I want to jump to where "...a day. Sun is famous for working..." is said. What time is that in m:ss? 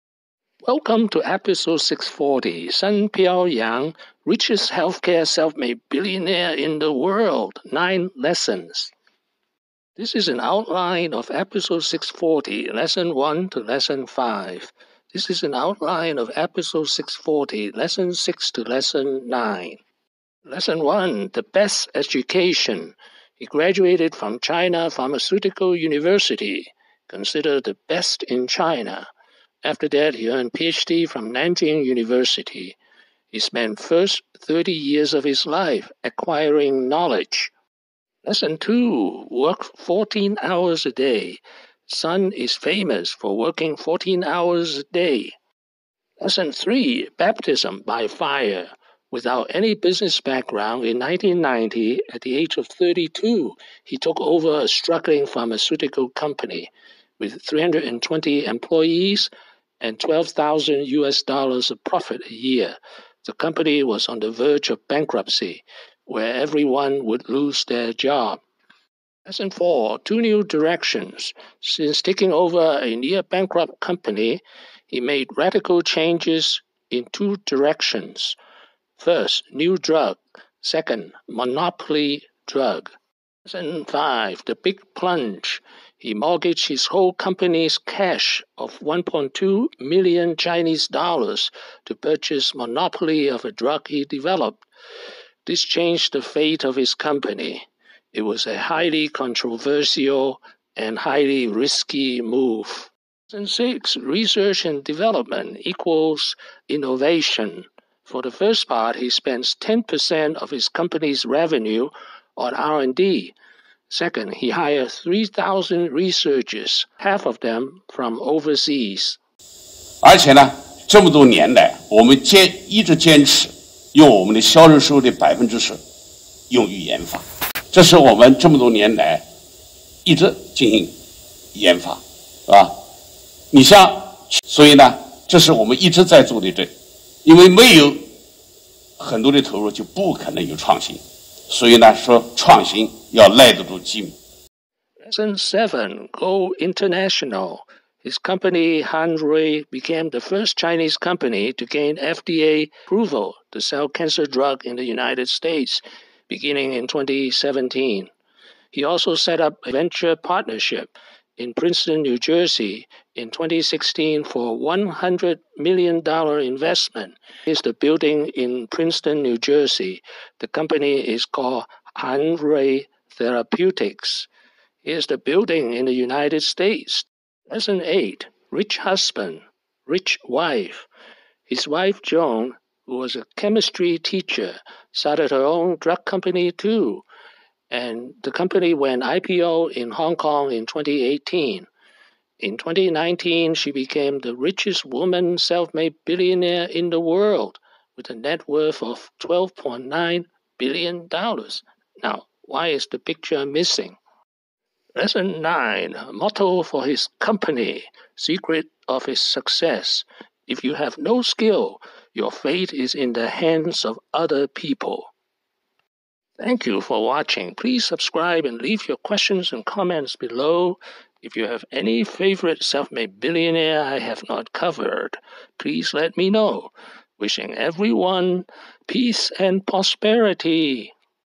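0:40.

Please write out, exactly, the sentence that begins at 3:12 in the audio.
In 2019, she became the richest woman self made billionaire in the world with a net worth of $12.9 billion.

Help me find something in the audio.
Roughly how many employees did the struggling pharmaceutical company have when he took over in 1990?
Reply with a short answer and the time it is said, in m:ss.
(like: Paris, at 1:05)
320, at 0:57.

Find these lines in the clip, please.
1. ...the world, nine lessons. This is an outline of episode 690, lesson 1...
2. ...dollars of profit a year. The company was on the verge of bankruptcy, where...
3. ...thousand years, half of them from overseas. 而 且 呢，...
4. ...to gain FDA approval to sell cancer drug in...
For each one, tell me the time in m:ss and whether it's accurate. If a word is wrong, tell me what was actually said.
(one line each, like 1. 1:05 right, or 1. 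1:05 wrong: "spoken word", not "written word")
1. 0:06 wrong: "640", not "690"
2. 1:01 right
3. 1:55 wrong: "researchers", not "years"
4. 2:31 right.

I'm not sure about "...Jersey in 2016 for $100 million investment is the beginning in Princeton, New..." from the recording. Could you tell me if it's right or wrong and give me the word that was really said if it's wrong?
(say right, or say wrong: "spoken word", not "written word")
wrong: "building", not "beginning".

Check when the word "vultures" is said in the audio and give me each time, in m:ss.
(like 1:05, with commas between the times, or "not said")
not said.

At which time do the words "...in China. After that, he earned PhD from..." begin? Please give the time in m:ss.
0:28.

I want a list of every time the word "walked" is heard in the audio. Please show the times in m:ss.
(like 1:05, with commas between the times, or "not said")
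not said.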